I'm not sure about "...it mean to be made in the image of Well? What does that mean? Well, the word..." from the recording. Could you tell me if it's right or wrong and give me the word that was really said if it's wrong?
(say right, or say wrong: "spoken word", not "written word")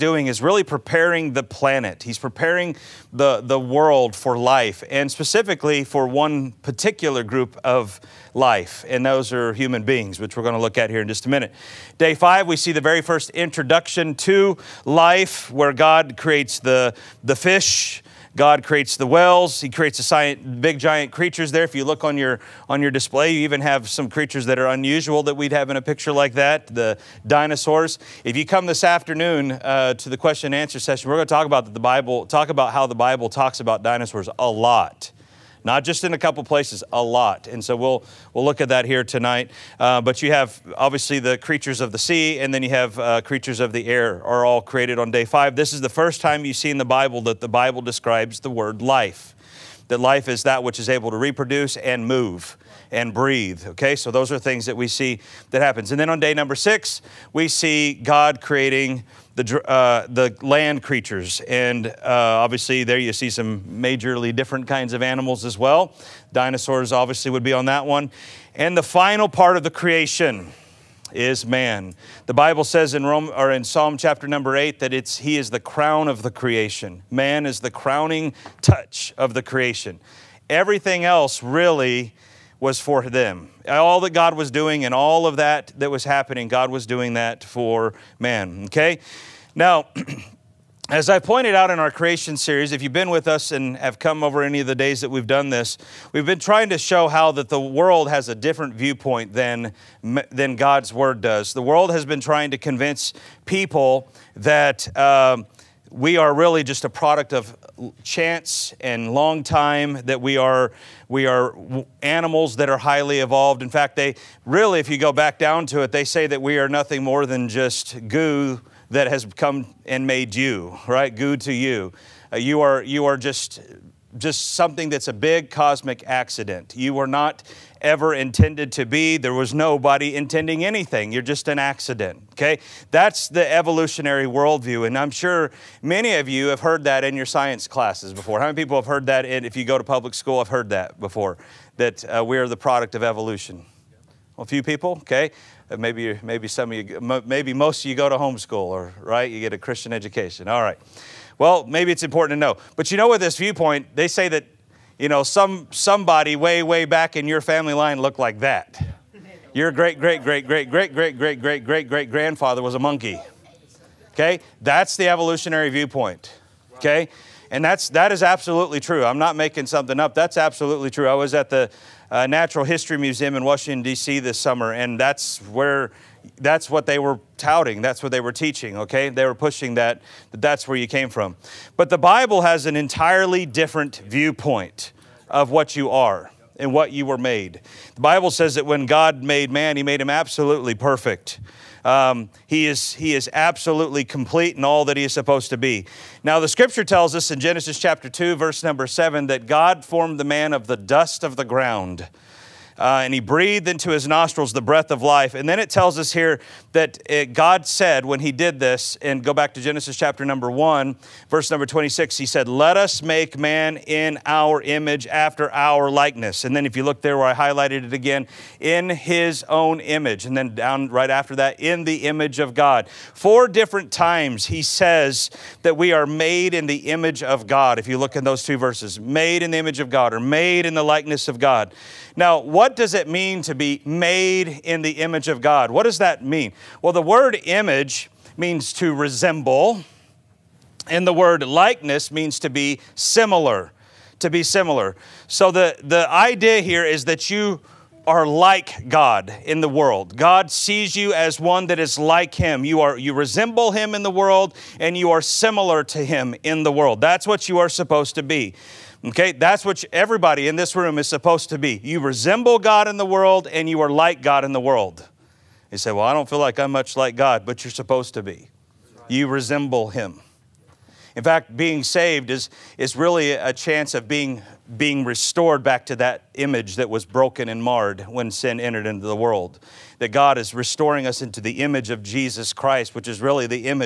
wrong: "God", not "Well".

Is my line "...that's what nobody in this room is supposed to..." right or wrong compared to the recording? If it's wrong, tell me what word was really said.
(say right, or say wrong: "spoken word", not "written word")
wrong: "everybody", not "nobody".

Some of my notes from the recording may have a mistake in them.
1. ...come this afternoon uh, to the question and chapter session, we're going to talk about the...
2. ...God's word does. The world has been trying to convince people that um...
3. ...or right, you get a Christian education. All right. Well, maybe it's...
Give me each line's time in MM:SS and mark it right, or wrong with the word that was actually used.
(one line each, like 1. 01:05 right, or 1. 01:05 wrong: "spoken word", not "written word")
1. 00:28 wrong: "answer", not "chapter"
2. 01:40 right
3. 02:28 right.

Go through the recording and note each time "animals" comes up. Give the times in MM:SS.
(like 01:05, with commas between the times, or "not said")
01:05, 01:52.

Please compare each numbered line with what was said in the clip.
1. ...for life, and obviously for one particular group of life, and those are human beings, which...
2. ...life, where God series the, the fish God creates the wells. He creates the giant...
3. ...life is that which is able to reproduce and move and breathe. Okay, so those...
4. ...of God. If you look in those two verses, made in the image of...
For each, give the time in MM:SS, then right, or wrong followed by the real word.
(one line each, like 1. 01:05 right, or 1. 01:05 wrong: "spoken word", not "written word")
1. 00:04 wrong: "specifically", not "obviously"
2. 00:14 wrong: "creates", not "series"
3. 00:50 right
4. 03:47 right.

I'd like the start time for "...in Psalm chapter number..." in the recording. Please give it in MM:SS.
01:13.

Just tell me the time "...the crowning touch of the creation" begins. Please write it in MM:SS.
01:17.